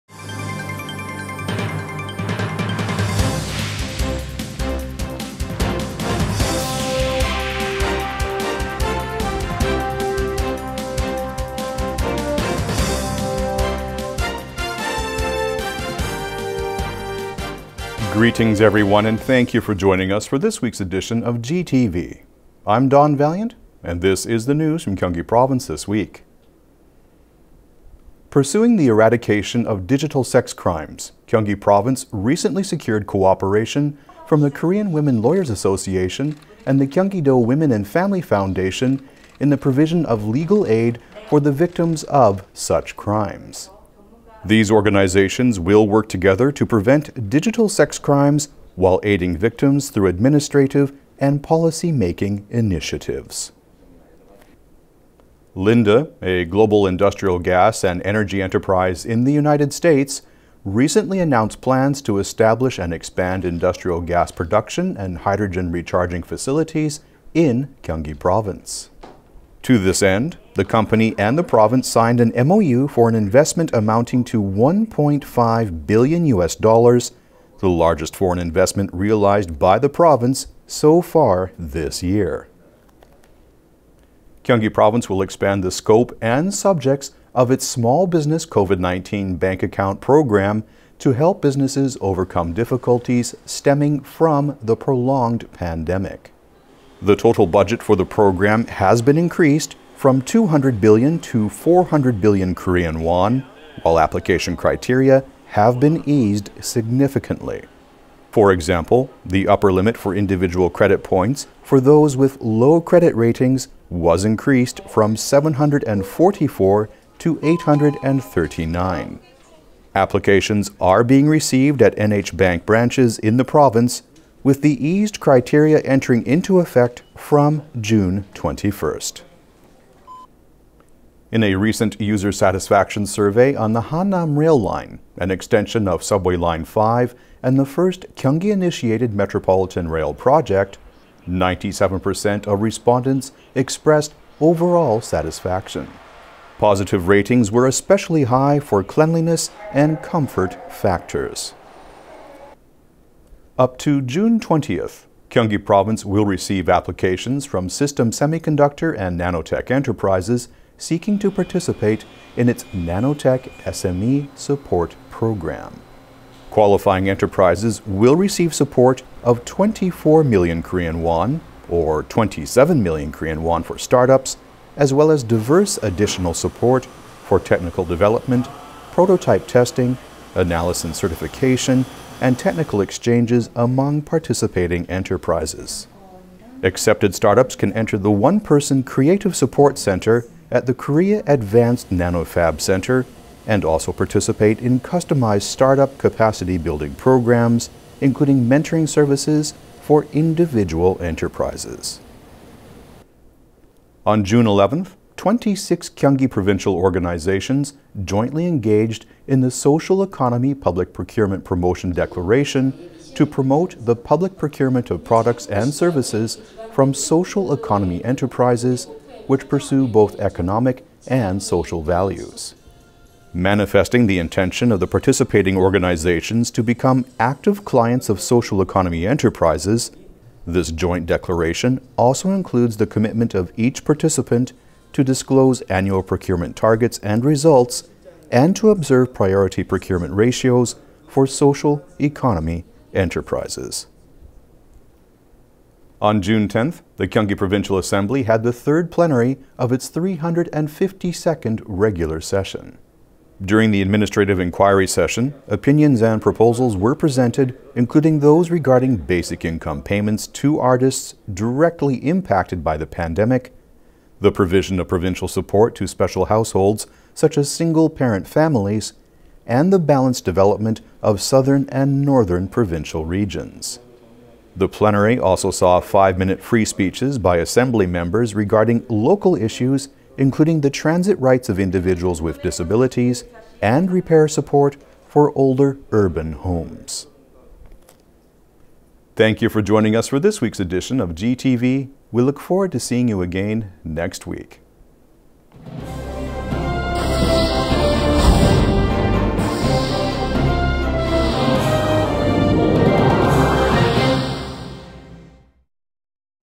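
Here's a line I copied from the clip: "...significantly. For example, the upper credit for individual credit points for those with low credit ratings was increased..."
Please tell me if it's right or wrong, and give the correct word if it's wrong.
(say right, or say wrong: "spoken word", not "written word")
wrong: "limit", not "credit".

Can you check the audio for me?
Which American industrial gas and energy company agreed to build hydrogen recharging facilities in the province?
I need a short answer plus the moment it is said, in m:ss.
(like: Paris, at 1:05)
Linde, at 0:55.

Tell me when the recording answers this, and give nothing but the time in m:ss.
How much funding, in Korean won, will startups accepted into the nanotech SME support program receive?
2:52.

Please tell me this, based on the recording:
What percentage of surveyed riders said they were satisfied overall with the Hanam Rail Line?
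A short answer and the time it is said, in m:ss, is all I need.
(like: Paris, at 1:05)
97%, at 2:21.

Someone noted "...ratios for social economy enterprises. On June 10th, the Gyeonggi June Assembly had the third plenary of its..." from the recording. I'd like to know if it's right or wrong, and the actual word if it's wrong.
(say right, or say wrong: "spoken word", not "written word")
wrong: "Provincial", not "June".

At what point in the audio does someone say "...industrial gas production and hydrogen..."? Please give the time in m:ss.
1:03.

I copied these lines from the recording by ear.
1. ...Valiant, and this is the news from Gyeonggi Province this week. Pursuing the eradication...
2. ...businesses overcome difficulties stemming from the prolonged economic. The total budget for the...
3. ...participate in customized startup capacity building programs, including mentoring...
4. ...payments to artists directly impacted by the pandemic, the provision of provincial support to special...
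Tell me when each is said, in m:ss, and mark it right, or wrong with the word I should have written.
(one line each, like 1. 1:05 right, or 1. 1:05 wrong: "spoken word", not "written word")
1. 0:23 right
2. 1:31 wrong: "pandemic", not "economic"
3. 3:13 right
4. 4:19 right.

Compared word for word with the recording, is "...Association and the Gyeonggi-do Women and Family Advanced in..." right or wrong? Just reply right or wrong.
wrong.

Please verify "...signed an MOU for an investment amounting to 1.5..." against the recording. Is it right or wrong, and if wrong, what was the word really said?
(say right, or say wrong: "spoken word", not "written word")
right.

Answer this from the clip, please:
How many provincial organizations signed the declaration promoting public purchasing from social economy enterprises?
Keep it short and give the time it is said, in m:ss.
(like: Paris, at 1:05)
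26, at 3:25.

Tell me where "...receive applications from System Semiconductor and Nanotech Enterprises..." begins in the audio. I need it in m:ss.
2:36.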